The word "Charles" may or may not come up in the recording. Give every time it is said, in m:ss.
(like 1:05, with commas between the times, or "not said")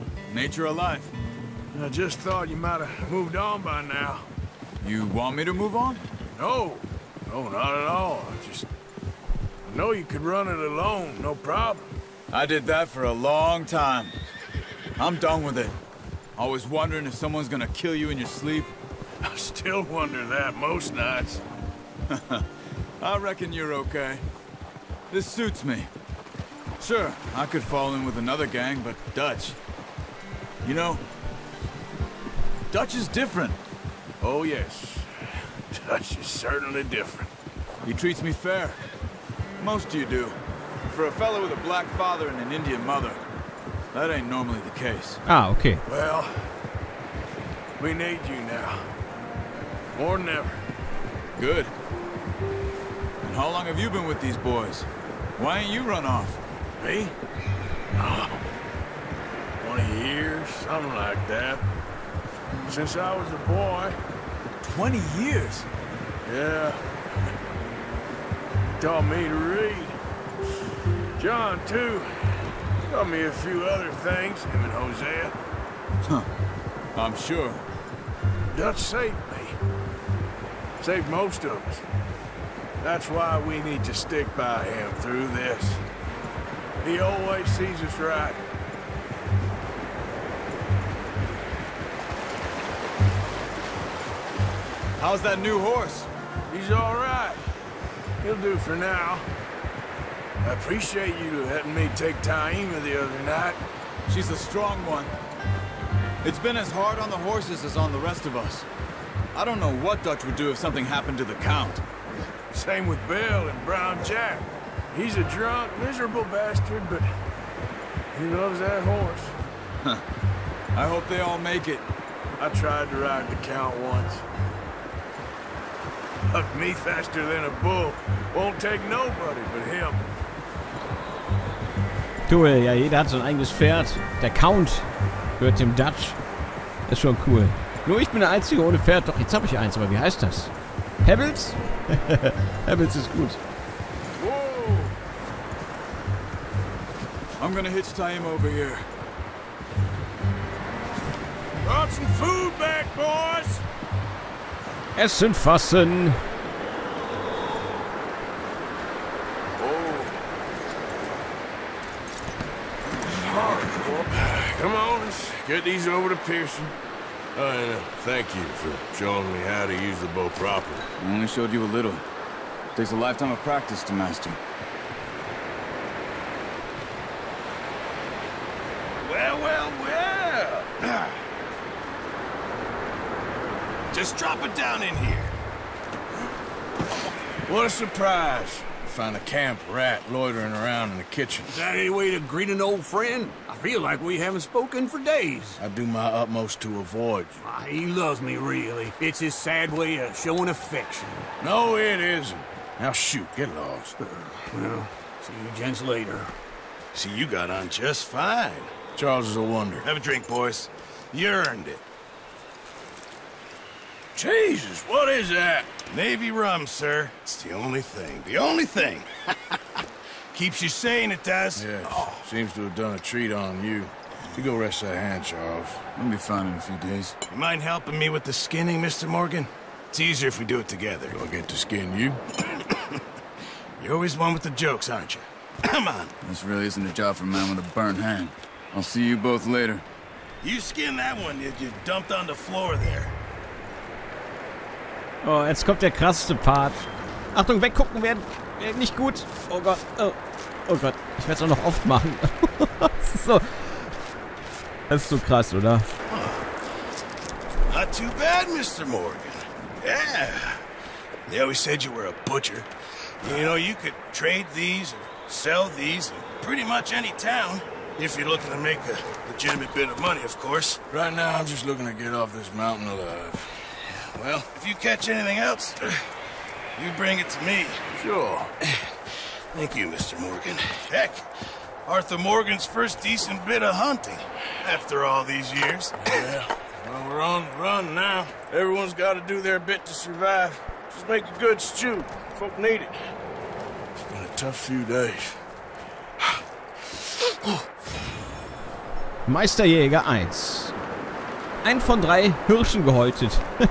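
3:28, 3:45.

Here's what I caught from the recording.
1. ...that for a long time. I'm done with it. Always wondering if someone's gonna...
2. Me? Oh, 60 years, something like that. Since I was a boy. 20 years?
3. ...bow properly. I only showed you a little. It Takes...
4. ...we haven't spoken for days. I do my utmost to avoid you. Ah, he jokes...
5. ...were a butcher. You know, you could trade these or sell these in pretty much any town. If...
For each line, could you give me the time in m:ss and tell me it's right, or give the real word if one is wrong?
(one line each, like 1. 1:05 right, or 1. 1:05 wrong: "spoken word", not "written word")
1. 0:12 right
2. 0:56 wrong: "20", not "60"
3. 2:50 right
4. 3:13 wrong: "loves", not "jokes"
5. 4:21 right.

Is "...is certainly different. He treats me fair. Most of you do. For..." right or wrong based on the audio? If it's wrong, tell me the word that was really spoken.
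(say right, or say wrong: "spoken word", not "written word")
right.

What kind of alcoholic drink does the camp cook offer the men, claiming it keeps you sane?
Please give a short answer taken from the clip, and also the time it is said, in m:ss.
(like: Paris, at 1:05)
Navy rum, at 3:35.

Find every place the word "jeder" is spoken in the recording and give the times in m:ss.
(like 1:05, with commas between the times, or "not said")
2:12.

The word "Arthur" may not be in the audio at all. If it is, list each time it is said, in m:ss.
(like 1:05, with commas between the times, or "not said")
4:41.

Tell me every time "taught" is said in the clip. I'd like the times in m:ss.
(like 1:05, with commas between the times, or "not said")
1:08, 1:12.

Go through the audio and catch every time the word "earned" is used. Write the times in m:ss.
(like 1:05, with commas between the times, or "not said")
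3:31.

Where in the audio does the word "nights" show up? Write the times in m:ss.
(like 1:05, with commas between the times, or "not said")
0:20, 1:43.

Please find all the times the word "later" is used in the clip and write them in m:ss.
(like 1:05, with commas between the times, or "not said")
3:25, 3:59.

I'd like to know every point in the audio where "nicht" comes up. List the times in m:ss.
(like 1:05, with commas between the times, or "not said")
4:08.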